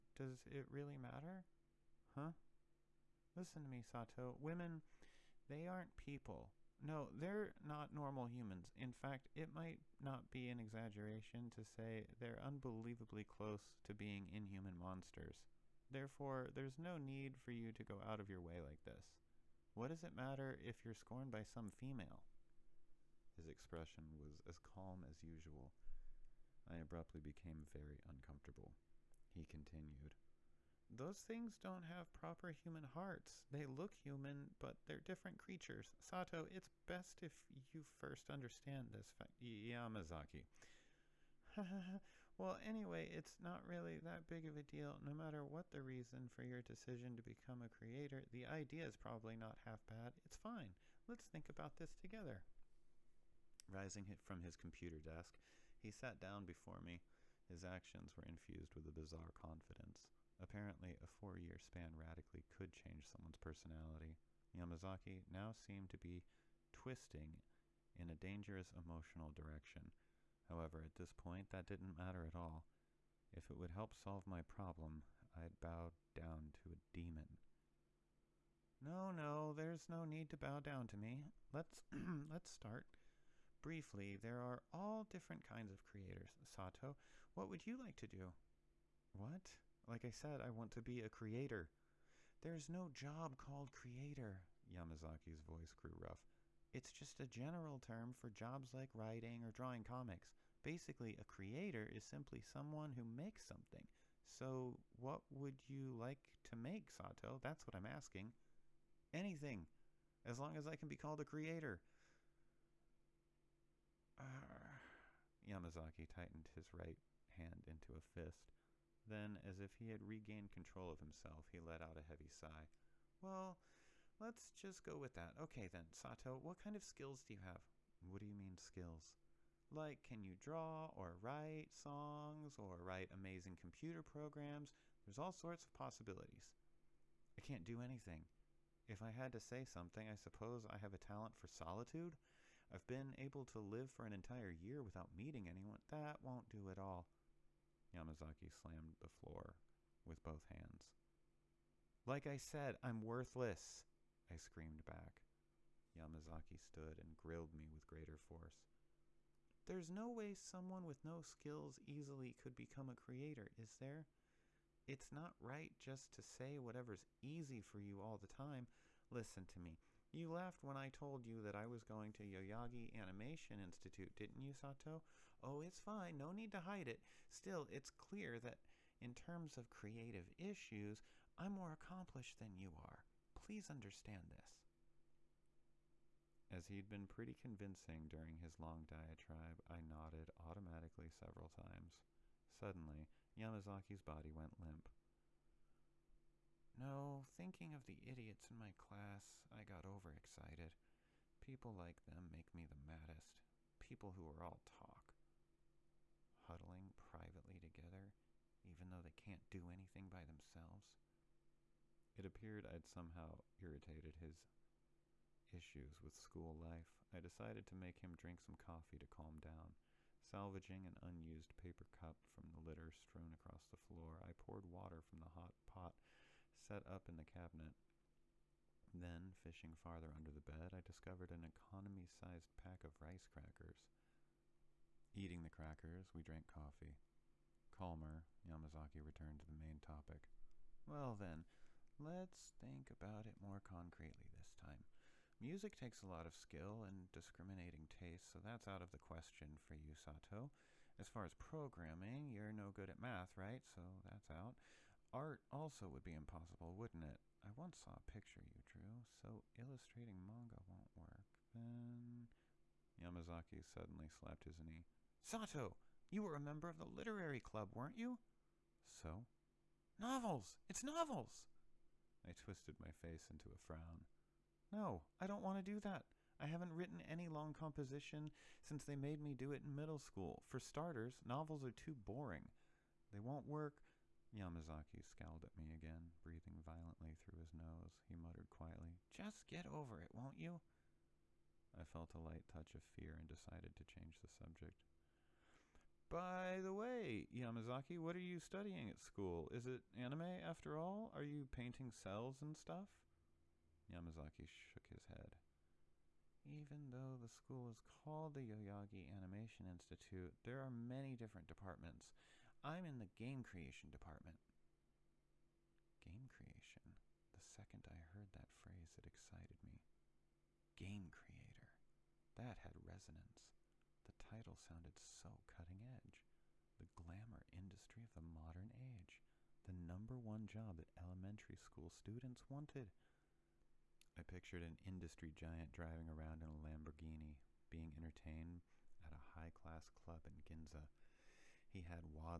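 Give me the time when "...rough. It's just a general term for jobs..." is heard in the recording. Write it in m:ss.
1:35.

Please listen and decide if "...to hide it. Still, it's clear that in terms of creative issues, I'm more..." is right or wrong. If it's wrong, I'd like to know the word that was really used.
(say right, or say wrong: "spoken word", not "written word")
right.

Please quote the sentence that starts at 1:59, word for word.
Then, as if he had regained control of himself, he let out a heavy sigh.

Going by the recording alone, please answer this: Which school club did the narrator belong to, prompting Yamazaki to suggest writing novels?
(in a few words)
Literary club.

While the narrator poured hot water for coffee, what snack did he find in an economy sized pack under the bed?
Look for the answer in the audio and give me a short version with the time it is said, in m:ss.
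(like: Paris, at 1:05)
Rice crackers, at 3:53.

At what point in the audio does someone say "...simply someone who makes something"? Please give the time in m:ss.
1:42.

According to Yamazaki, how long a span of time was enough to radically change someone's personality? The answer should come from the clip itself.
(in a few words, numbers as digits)
4 years.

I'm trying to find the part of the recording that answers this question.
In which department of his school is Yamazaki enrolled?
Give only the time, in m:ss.
5:13.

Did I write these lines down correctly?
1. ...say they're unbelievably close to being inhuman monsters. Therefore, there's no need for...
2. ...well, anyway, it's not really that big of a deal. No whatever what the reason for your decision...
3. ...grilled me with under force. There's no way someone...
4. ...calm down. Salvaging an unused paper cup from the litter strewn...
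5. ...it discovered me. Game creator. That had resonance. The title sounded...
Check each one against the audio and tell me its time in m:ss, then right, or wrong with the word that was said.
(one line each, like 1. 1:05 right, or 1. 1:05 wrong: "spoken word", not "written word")
1. 0:11 right
2. 0:42 wrong: "matter", not "whatever"
3. 2:37 wrong: "greater", not "under"
4. 3:39 right
5. 5:18 wrong: "excited", not "discovered".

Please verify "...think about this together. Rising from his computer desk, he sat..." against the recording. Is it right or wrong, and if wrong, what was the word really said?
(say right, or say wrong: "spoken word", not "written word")
right.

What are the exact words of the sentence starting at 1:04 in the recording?
Yamazaki now seemed to be twisting in a dangerous emotional direction.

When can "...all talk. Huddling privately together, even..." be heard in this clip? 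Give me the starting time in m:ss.
3:24.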